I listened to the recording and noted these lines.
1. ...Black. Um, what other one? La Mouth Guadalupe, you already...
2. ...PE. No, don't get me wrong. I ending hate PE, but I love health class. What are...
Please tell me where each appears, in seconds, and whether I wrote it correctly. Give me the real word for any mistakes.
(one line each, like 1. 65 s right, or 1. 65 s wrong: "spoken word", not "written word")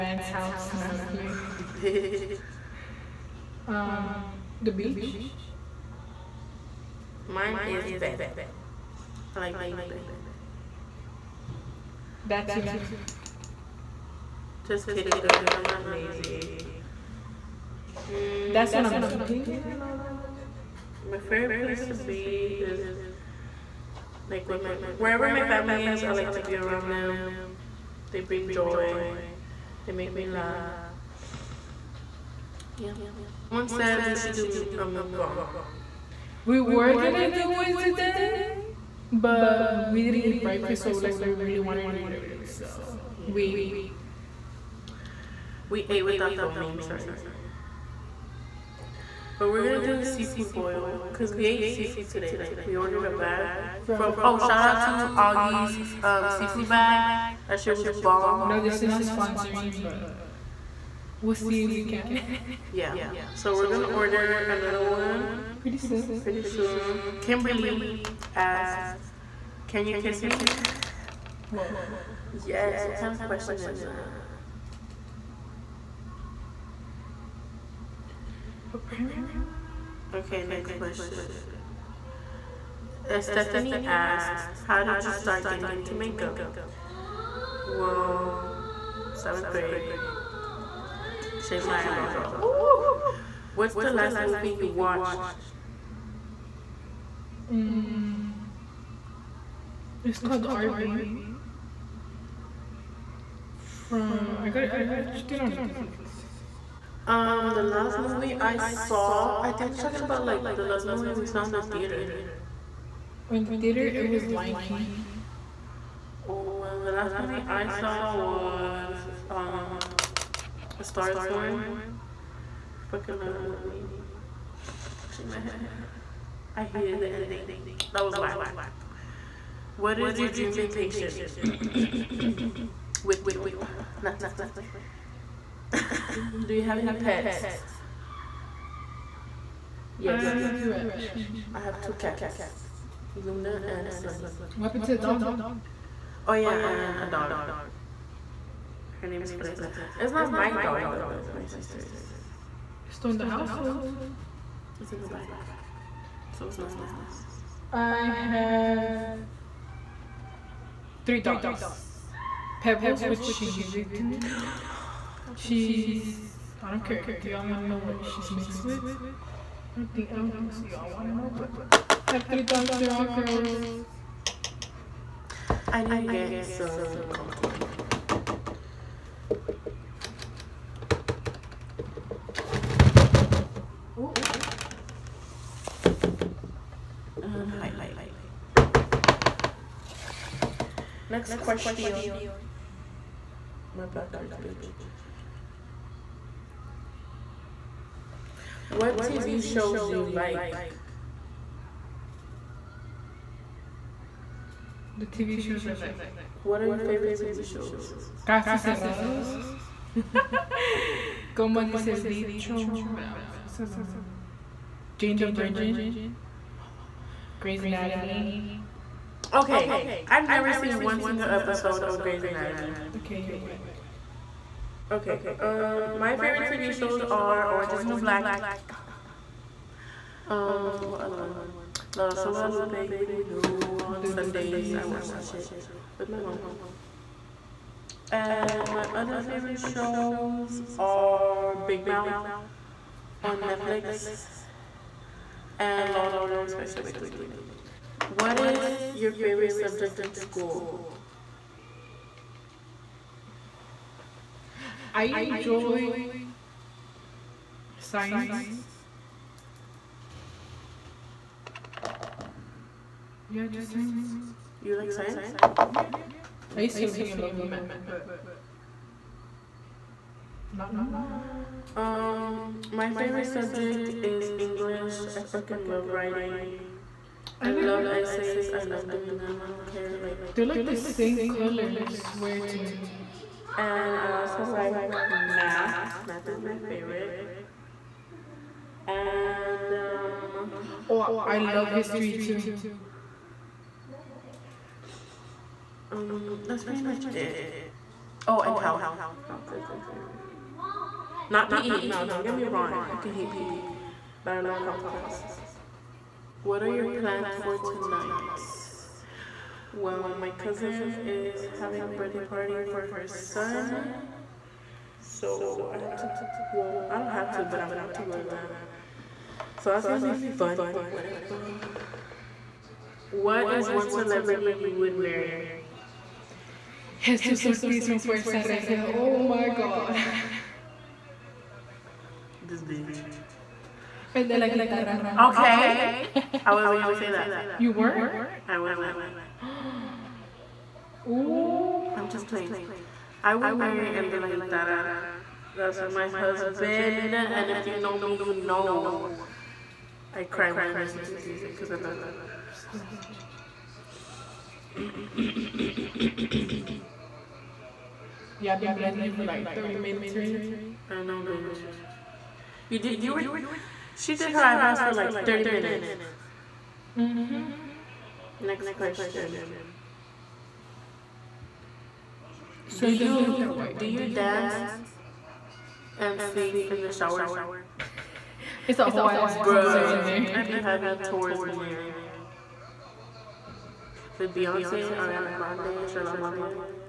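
1. 227 s wrong: "Rosa", not "Mouth"
2. 301 s wrong: "fucking", not "ending".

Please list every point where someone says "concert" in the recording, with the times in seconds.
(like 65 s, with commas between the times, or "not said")
379 s.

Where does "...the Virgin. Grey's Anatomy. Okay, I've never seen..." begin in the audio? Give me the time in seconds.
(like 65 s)
215 s.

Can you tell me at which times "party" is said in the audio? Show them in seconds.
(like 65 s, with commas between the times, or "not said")
312 s.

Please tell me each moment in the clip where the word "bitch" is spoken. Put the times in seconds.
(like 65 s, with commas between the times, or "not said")
1 s, 194 s, 332 s, 361 s.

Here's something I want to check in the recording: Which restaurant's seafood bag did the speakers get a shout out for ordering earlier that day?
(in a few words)
Auggie's.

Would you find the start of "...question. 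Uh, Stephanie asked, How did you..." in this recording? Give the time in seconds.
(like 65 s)
80 s.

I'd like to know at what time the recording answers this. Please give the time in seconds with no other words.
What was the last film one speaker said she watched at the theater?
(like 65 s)
114 s.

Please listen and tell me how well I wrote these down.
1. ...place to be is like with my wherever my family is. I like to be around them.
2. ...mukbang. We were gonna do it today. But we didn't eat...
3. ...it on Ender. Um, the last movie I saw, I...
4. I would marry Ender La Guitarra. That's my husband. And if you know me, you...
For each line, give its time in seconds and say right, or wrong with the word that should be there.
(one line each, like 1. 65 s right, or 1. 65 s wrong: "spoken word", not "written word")
1. 21 s right
2. 34 s right
3. 105 s wrong: "Netflix", not "Ender"
4. 343 s right.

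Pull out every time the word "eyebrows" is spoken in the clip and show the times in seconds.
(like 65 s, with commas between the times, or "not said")
91 s, 364 s.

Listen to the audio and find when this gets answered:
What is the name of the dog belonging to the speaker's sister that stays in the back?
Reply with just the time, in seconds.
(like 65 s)
149 s.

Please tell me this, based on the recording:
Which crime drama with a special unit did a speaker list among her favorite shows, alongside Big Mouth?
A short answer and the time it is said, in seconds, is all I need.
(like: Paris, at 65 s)
Law and Order Special Victims Unit, at 245 s.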